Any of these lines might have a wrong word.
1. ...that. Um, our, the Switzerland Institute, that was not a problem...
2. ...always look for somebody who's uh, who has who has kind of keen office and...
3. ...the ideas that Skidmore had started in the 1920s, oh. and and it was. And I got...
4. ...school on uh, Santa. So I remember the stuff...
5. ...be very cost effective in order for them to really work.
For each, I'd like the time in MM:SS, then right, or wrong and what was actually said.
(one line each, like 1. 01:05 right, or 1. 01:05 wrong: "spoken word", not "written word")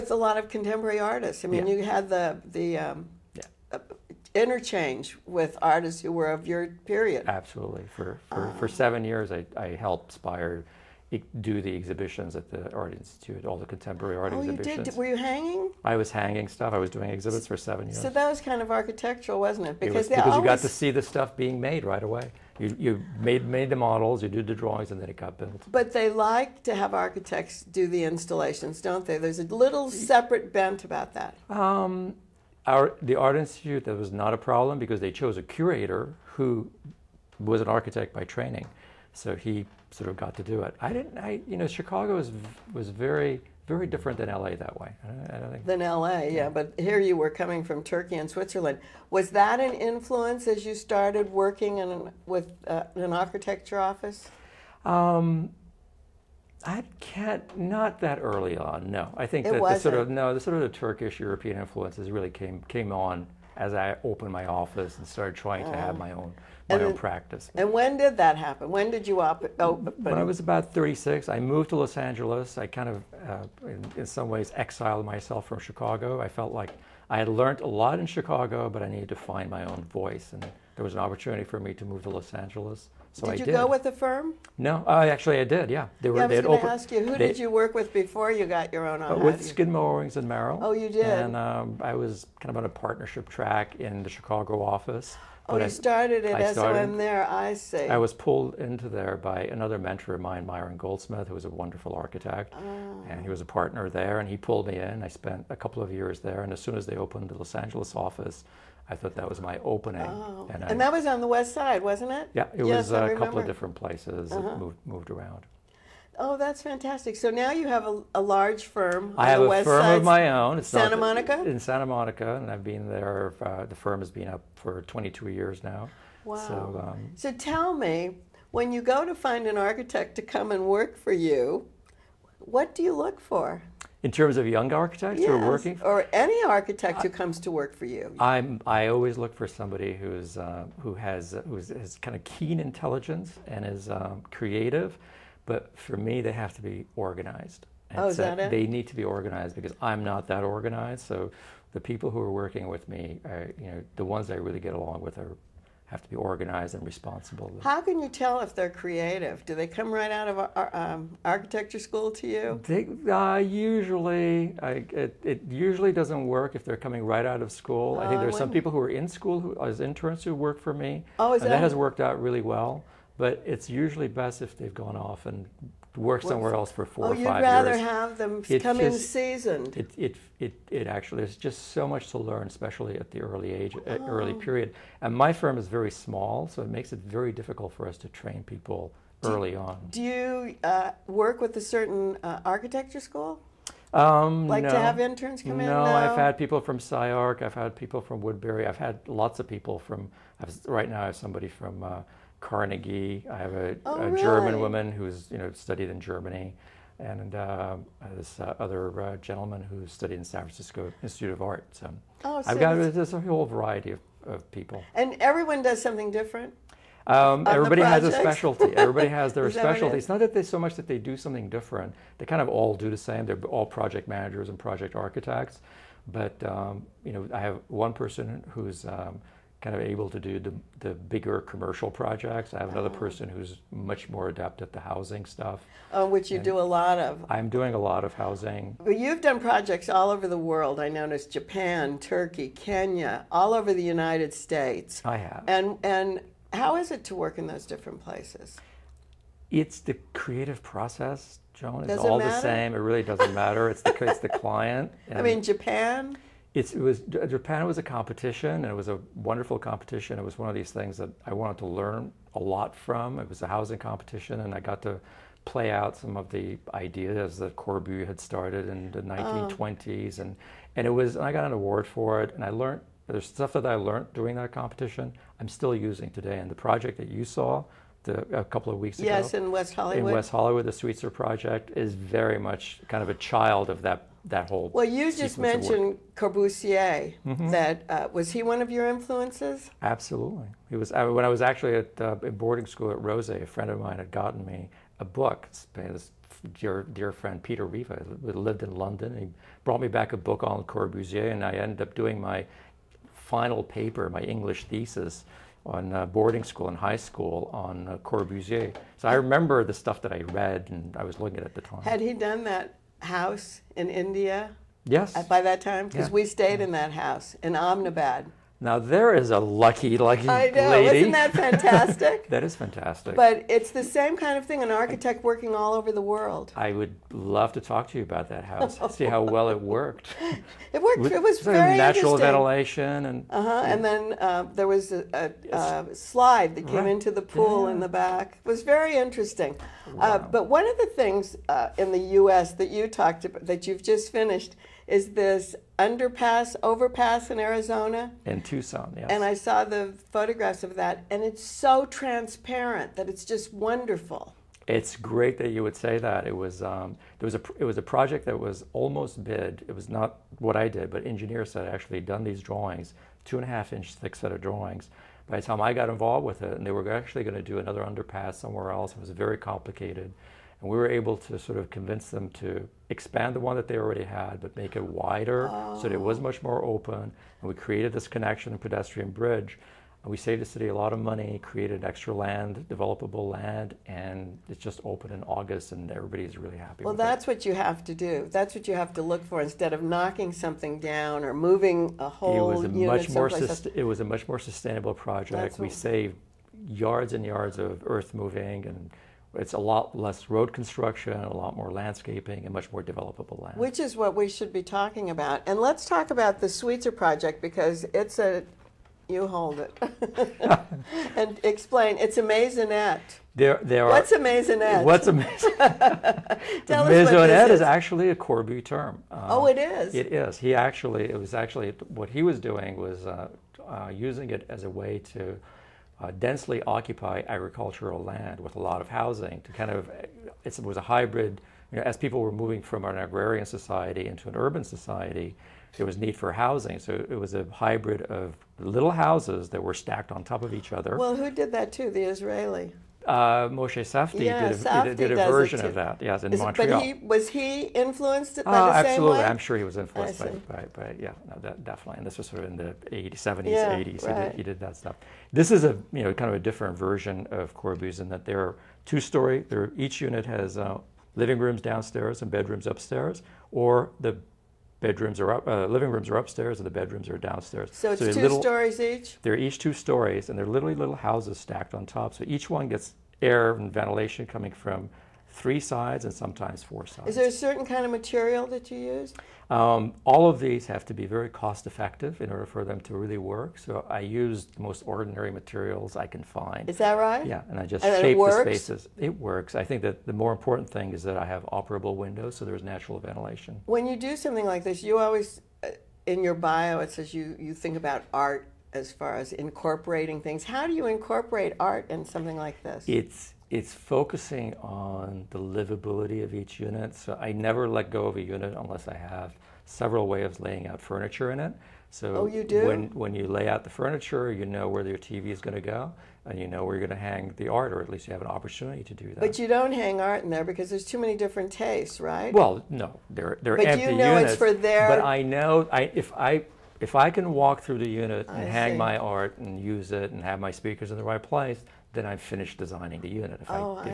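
1. 00:31 wrong: "Art", not "Switzerland"
2. 02:18 wrong: "intelligence", not "office"
3. 04:26 wrong: "Corbu", not "Skidmore"
4. 05:06 wrong: "Corbusier", not "Santa"
5. 08:00 right.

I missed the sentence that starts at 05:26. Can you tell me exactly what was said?
I would love to talk to you about that house.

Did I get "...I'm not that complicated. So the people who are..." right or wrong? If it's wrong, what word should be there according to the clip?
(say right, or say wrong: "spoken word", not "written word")
wrong: "organized", not "complicated".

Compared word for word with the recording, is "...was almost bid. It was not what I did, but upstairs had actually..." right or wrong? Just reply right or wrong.
wrong.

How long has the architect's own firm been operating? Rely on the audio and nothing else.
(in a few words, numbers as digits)
22 years.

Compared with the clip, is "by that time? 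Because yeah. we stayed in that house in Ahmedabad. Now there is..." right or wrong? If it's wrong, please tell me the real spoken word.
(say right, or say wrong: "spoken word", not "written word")
right.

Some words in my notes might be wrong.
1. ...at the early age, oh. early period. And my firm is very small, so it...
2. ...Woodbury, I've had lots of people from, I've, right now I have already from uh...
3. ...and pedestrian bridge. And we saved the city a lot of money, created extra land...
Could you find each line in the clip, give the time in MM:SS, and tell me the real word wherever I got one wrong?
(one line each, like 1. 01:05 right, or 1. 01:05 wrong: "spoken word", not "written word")
1. 03:02 right
2. 03:18 wrong: "somebody", not "already"
3. 06:18 right.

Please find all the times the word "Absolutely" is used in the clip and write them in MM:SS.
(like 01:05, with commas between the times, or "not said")
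00:07, 04:49, 07:28.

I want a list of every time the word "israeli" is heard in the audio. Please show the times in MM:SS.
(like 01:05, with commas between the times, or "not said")
07:22.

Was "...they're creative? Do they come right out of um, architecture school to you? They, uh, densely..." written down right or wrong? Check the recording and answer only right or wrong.
wrong.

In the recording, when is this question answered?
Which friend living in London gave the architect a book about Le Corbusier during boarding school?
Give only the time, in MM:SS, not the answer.
04:57.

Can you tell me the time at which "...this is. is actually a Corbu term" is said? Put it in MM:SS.
06:57.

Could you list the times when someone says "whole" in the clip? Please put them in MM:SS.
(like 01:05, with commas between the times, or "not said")
03:33, 04:44, 06:32.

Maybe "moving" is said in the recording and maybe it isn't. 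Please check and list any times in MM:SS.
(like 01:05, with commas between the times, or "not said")
06:31, 06:38, 07:12.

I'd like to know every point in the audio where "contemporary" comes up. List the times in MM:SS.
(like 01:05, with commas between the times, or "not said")
00:00, 00:13.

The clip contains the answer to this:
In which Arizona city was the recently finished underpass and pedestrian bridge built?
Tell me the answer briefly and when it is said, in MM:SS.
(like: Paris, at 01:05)
Tucson, at 05:48.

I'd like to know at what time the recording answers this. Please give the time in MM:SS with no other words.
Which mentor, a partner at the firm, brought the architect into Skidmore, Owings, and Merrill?
01:40.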